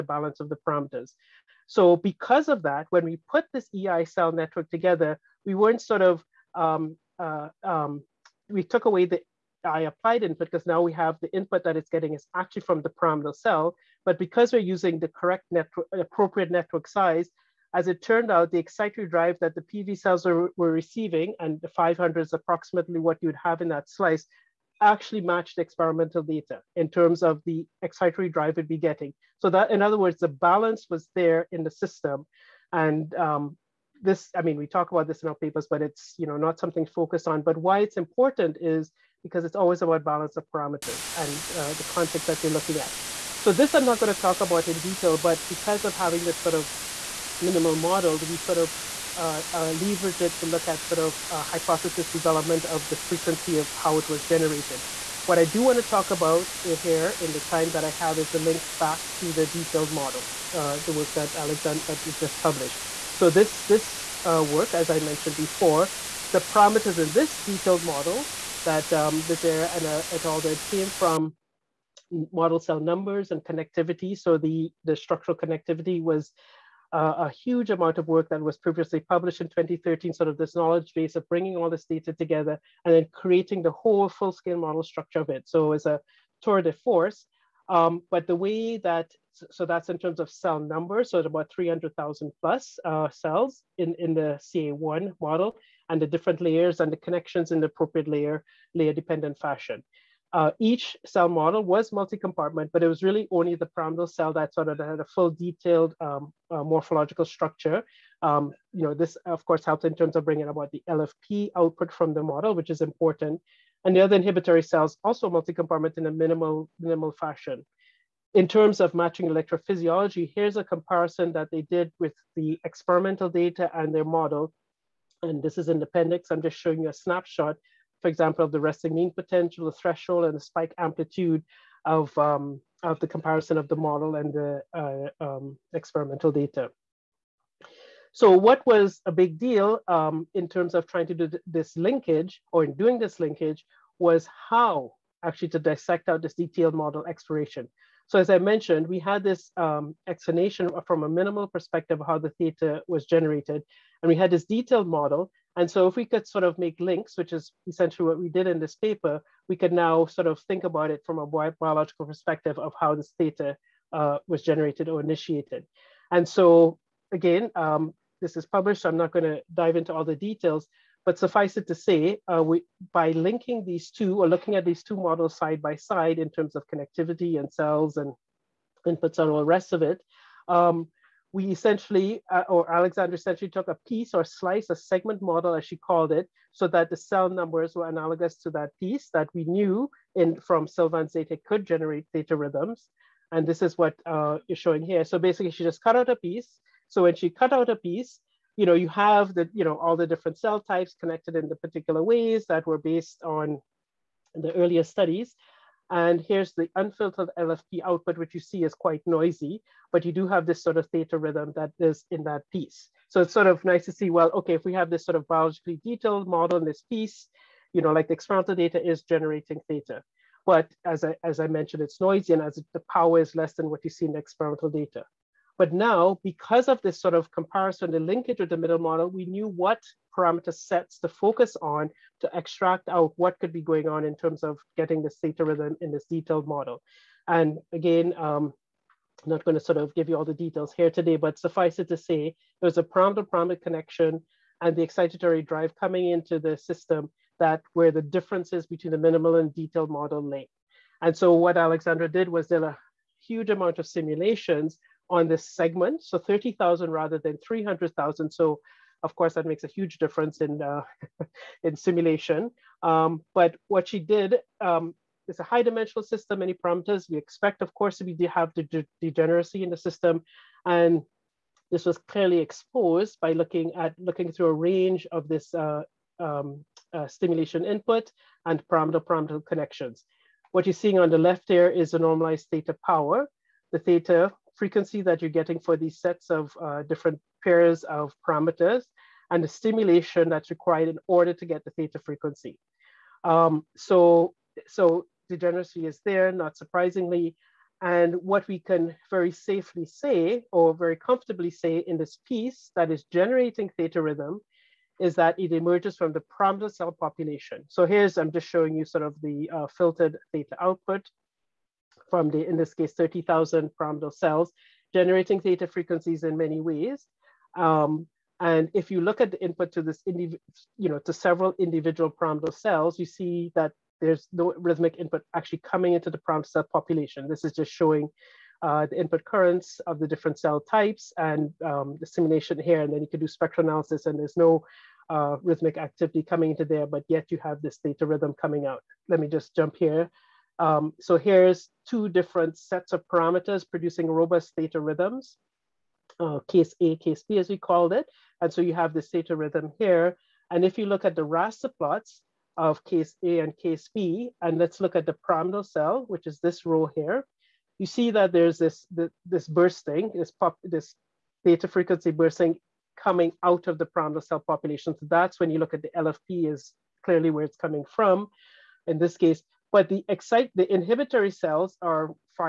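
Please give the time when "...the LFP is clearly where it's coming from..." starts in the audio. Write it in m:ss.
6:05.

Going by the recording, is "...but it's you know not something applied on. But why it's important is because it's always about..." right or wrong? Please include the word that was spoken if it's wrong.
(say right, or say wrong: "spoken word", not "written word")
wrong: "focused", not "applied".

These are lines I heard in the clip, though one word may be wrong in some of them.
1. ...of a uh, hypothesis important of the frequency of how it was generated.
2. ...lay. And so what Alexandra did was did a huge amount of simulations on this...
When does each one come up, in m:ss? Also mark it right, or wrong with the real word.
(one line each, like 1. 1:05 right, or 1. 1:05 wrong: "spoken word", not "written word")
1. 0:50 wrong: "development", not "important"
2. 4:10 right.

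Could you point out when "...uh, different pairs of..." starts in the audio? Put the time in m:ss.
4:46.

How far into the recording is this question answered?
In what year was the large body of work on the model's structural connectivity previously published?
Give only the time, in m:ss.
1:19.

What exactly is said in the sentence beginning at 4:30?
And this was clearly exposed by looking at looking through a range of this uh, um, uh, stimulation input and pyramidal-pyramidal connections.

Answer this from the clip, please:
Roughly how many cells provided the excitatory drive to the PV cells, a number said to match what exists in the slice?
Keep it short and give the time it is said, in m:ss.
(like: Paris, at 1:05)
500, at 0:21.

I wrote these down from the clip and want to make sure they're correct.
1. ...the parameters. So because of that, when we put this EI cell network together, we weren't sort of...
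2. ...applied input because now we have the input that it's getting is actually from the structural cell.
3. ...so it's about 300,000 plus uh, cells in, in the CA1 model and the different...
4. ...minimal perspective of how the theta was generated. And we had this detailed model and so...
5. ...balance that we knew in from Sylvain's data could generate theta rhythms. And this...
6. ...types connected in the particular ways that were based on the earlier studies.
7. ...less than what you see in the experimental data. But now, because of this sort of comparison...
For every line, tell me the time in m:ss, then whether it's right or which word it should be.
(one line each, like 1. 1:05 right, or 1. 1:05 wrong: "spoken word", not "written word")
1. 0:00 right
2. 0:09 wrong: "pyramidal", not "structural"
3. 1:31 right
4. 2:31 right
5. 3:08 wrong: "piece", not "balance"
6. 3:20 right
7. 3:43 right.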